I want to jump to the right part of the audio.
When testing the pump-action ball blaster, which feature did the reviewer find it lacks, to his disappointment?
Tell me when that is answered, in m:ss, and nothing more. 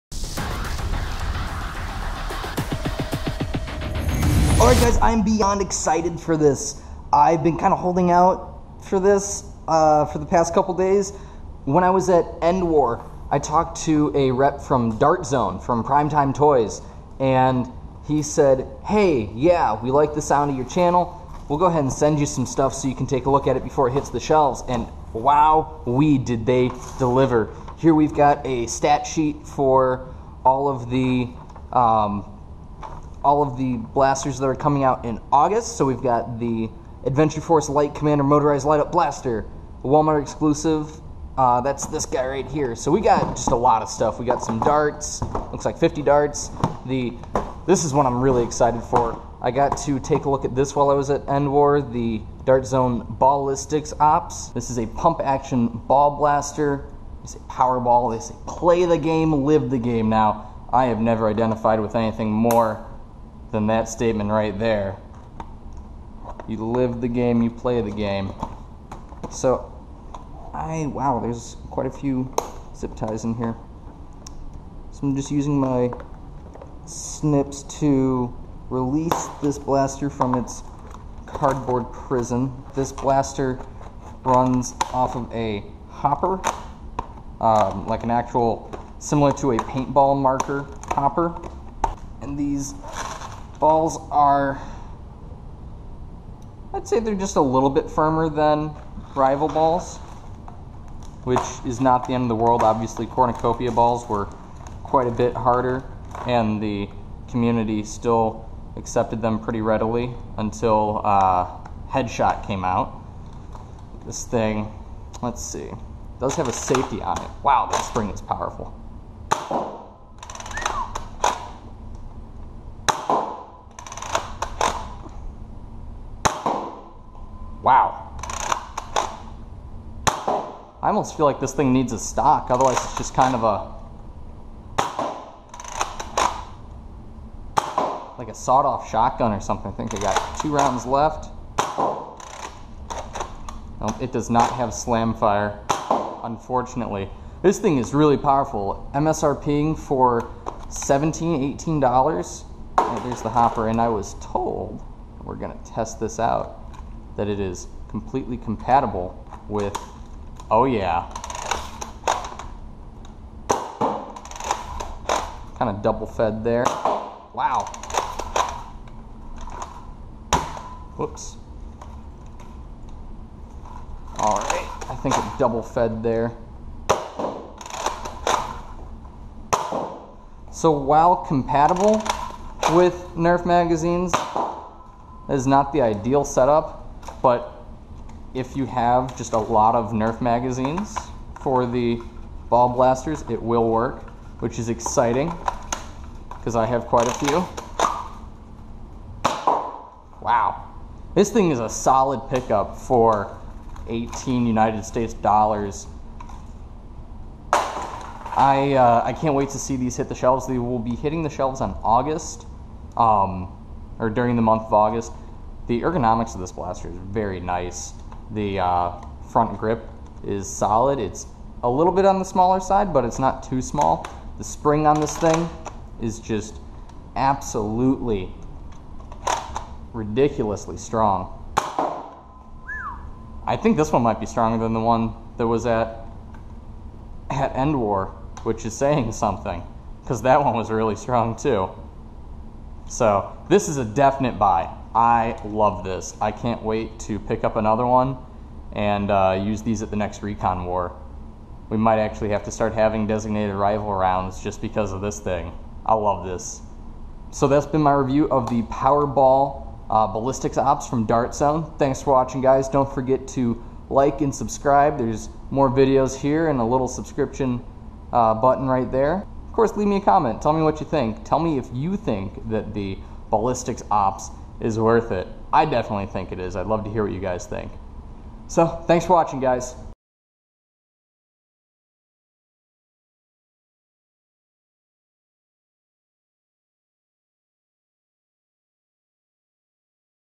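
2:24.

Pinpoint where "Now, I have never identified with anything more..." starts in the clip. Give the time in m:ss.
1:00.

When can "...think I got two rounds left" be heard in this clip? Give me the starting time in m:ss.
2:19.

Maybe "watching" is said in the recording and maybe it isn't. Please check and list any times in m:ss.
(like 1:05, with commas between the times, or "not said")
4:22, 4:39.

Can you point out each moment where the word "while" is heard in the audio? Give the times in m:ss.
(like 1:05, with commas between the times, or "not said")
0:50, 3:00.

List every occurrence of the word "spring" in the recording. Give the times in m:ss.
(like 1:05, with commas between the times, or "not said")
1:57, 3:44.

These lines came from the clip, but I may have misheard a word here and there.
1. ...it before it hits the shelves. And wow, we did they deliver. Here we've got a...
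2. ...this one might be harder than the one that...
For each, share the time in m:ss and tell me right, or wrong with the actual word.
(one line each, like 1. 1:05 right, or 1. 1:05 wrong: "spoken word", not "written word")
1. 0:23 right
2. 3:53 wrong: "stronger", not "harder".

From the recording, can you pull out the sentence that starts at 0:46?
The this is what I'm really excited for.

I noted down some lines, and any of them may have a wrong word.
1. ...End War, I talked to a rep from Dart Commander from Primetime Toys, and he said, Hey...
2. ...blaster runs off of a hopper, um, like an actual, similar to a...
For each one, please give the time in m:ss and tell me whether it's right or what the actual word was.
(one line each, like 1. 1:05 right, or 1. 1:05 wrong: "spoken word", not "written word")
1. 0:12 wrong: "Zone", not "Commander"
2. 1:22 right.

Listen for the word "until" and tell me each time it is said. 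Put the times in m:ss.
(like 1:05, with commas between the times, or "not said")
1:50.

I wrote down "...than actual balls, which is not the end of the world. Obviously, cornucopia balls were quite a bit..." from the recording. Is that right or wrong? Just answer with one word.
wrong.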